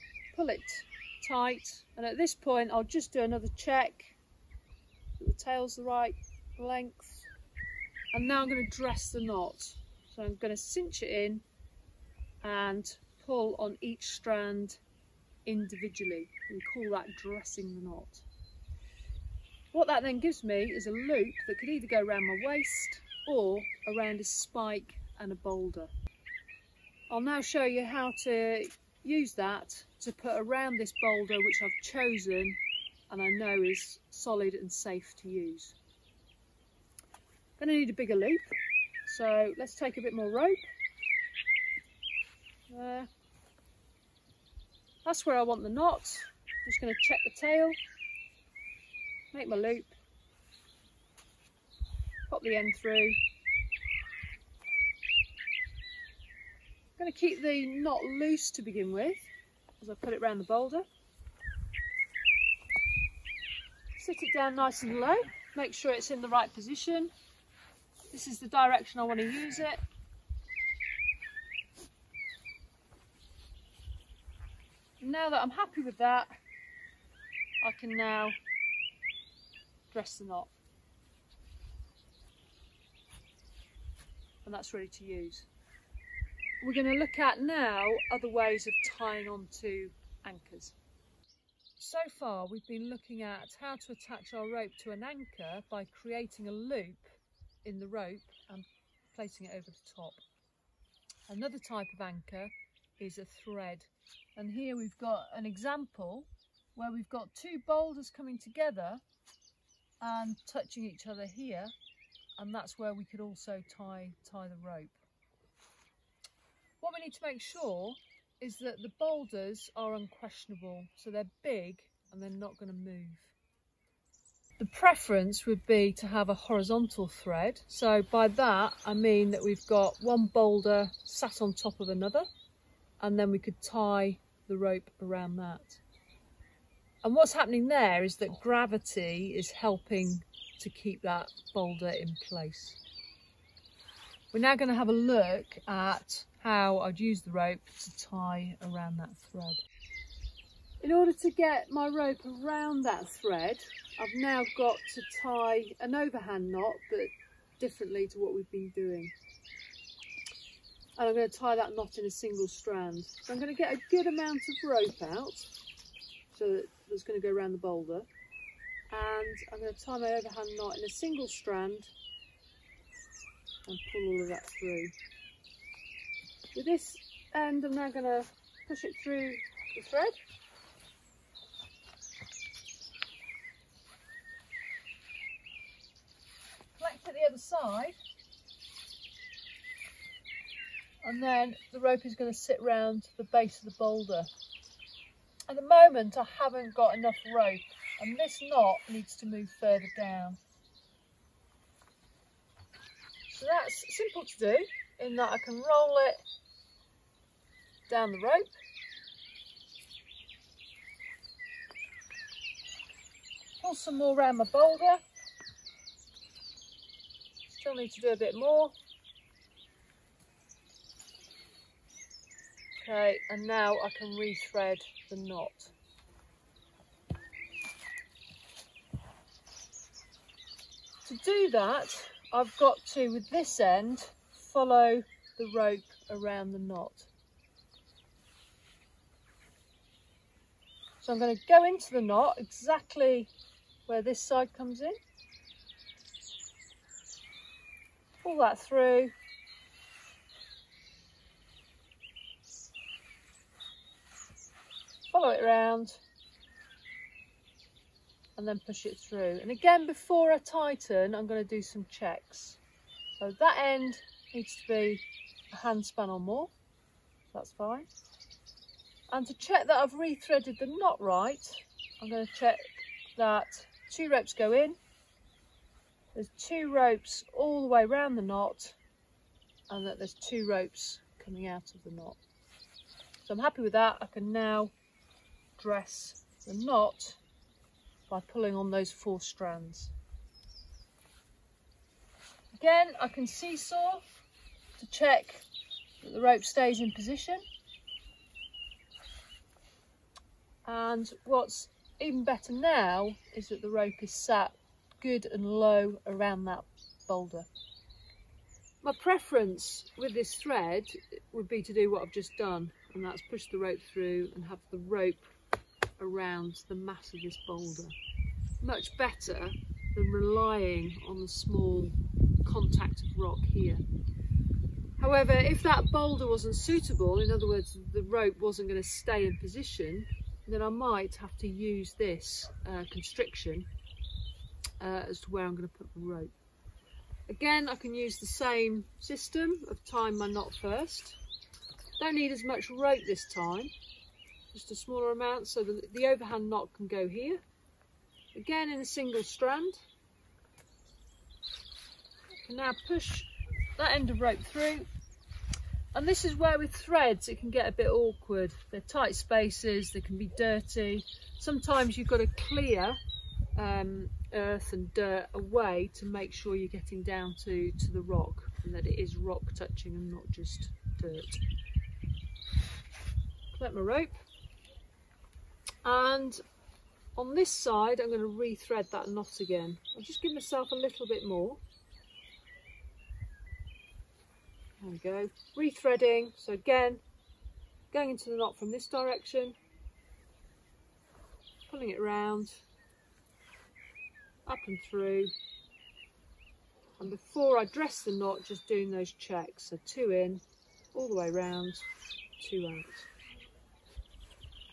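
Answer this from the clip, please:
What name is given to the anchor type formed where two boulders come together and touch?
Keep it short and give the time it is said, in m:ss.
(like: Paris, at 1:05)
A thread, at 1:43.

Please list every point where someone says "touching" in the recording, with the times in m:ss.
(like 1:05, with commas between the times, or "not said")
1:50, 6:09.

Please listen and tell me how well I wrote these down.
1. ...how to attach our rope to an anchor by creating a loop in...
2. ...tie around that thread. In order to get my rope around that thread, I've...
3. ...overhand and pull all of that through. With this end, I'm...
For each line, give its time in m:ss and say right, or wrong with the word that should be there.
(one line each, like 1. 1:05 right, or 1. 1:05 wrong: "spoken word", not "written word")
1. 1:33 right
2. 2:28 right
3. 2:51 wrong: "strand", not "overhand".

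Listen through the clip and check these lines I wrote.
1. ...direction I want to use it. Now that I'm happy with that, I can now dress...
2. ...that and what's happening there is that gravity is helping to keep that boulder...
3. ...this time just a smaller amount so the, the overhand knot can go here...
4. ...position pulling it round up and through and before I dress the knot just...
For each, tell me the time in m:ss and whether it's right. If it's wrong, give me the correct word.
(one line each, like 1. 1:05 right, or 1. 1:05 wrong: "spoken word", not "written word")
1. 1:08 right
2. 2:15 right
3. 5:43 right
4. 6:28 wrong: "direction", not "position".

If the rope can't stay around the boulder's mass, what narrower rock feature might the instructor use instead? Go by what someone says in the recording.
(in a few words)
Constriction.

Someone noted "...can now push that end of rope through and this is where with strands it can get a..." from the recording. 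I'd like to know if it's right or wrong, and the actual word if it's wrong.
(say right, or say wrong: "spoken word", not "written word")
wrong: "threads", not "strands".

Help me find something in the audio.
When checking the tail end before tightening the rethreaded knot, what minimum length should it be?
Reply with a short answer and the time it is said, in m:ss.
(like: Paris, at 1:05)
A hand span, at 4:25.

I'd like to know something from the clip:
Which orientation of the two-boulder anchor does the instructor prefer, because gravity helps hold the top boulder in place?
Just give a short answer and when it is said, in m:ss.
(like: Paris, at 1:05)
Horizontal, at 2:06.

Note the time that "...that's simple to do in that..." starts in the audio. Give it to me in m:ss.
3:23.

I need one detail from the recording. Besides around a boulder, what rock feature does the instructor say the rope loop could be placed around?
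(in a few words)
A spike.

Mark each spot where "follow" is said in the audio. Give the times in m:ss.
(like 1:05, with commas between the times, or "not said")
3:54, 4:15.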